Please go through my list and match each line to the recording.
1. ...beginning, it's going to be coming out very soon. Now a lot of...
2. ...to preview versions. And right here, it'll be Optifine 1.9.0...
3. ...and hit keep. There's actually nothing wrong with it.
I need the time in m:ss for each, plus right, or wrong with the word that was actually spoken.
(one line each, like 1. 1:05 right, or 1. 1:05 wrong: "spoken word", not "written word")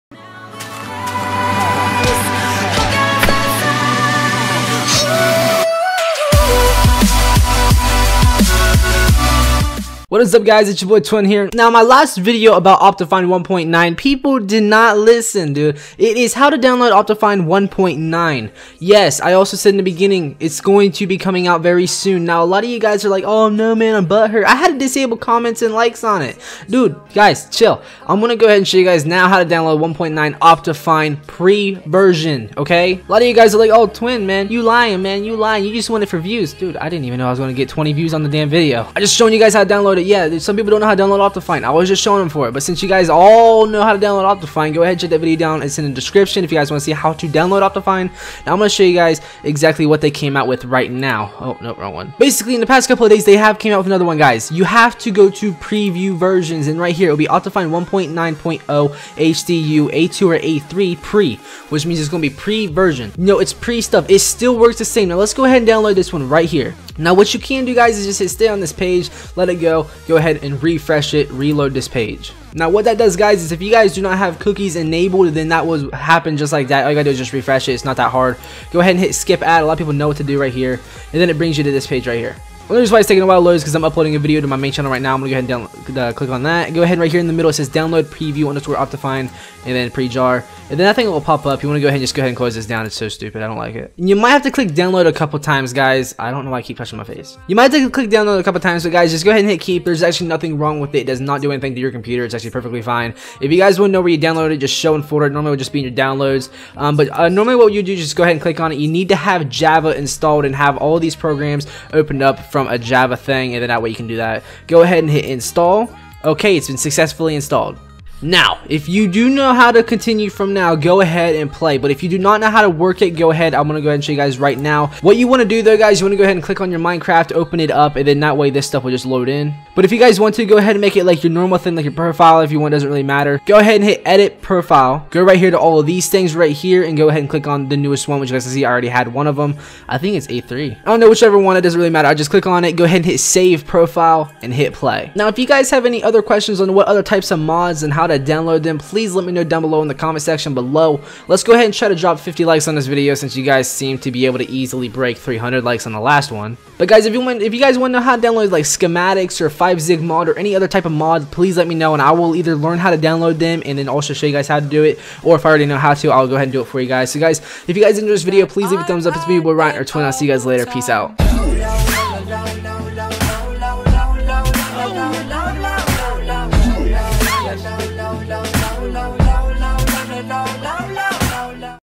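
1. 0:19 right
2. 0:55 right
3. 1:39 right.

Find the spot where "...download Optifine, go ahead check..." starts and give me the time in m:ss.
0:43.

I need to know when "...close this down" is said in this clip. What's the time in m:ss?
1:32.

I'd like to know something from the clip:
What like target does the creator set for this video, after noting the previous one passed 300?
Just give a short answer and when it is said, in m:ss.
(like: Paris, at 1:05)
50 likes, at 2:32.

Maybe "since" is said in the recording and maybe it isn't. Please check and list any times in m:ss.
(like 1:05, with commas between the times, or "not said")
0:42, 2:33.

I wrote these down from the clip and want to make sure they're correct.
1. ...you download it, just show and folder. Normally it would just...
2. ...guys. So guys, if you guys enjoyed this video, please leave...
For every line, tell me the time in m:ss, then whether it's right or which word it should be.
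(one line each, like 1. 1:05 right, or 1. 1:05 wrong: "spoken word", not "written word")
1. 1:44 right
2. 2:46 right.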